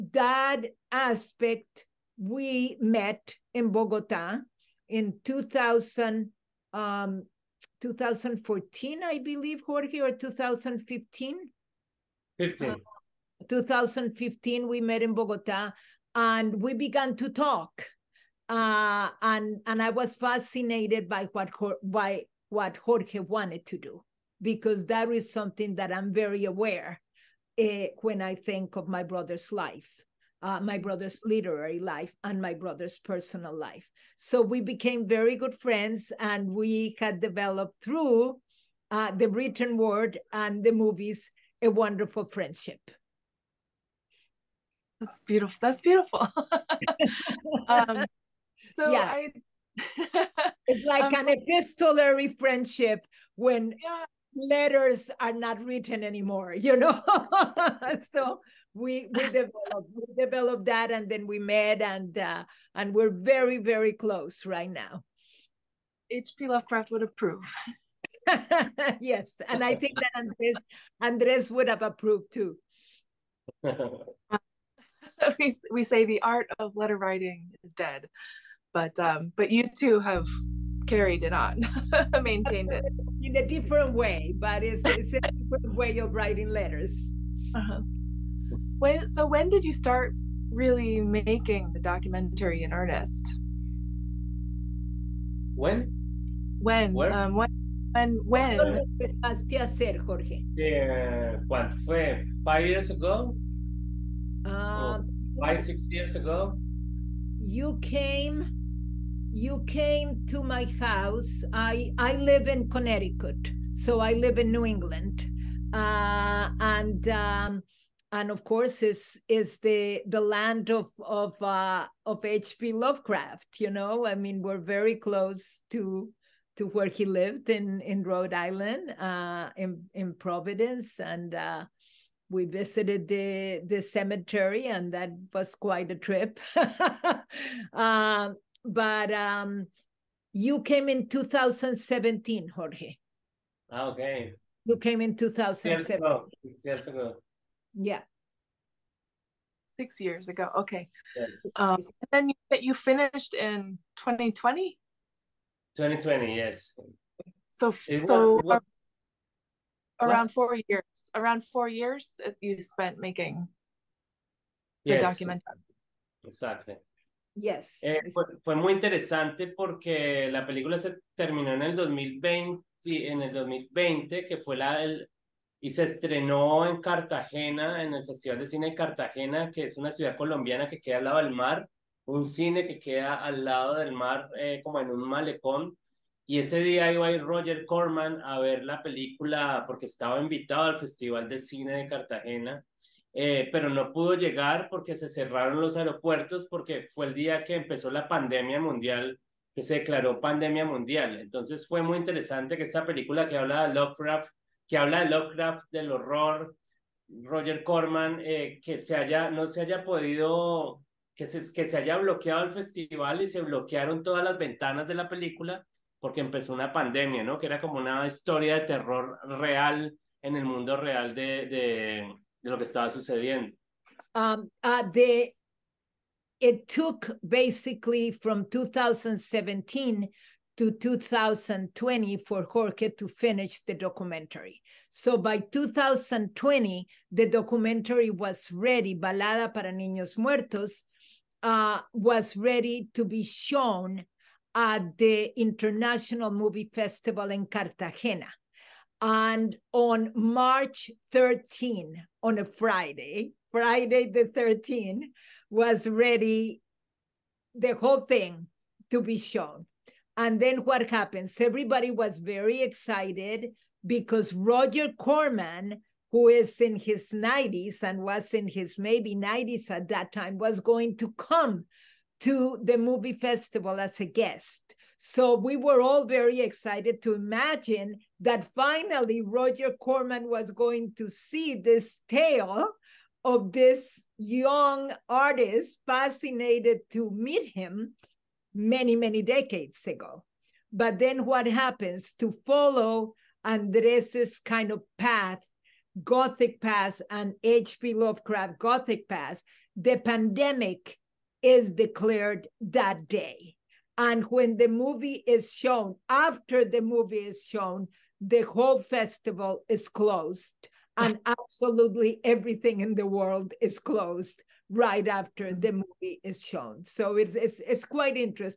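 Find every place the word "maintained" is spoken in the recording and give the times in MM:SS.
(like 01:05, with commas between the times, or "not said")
01:22.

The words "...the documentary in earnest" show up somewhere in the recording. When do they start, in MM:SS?
01:31.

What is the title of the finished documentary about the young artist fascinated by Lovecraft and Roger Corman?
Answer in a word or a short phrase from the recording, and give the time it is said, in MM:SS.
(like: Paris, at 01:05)
Balada para Niños Muertos, at 03:58.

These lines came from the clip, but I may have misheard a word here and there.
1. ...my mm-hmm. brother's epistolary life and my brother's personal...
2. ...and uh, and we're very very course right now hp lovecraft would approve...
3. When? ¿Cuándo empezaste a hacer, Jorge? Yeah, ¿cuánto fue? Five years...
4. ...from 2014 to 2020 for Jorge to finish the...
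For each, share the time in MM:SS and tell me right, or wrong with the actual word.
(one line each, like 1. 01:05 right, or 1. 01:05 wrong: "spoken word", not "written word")
1. 00:30 wrong: "literary", not "epistolary"
2. 01:01 wrong: "close", not "course"
3. 01:38 right
4. 03:48 wrong: "2017", not "2014".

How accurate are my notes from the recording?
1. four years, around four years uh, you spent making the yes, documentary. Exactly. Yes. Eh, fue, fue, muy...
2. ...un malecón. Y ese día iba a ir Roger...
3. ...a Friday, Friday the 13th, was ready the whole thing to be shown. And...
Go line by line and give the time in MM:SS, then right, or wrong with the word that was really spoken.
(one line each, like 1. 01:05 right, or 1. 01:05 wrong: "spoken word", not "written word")
1. 02:40 right
2. 03:04 right
3. 04:12 right.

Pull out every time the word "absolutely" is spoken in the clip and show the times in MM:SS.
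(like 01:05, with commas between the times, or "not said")
05:11.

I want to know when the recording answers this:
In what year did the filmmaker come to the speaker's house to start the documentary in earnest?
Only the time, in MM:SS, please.
02:20.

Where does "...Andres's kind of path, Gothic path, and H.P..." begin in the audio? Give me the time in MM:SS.
04:53.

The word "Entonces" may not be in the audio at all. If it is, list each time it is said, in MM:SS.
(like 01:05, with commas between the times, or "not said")
03:21.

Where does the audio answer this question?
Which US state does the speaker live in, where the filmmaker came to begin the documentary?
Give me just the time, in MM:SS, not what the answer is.
01:51.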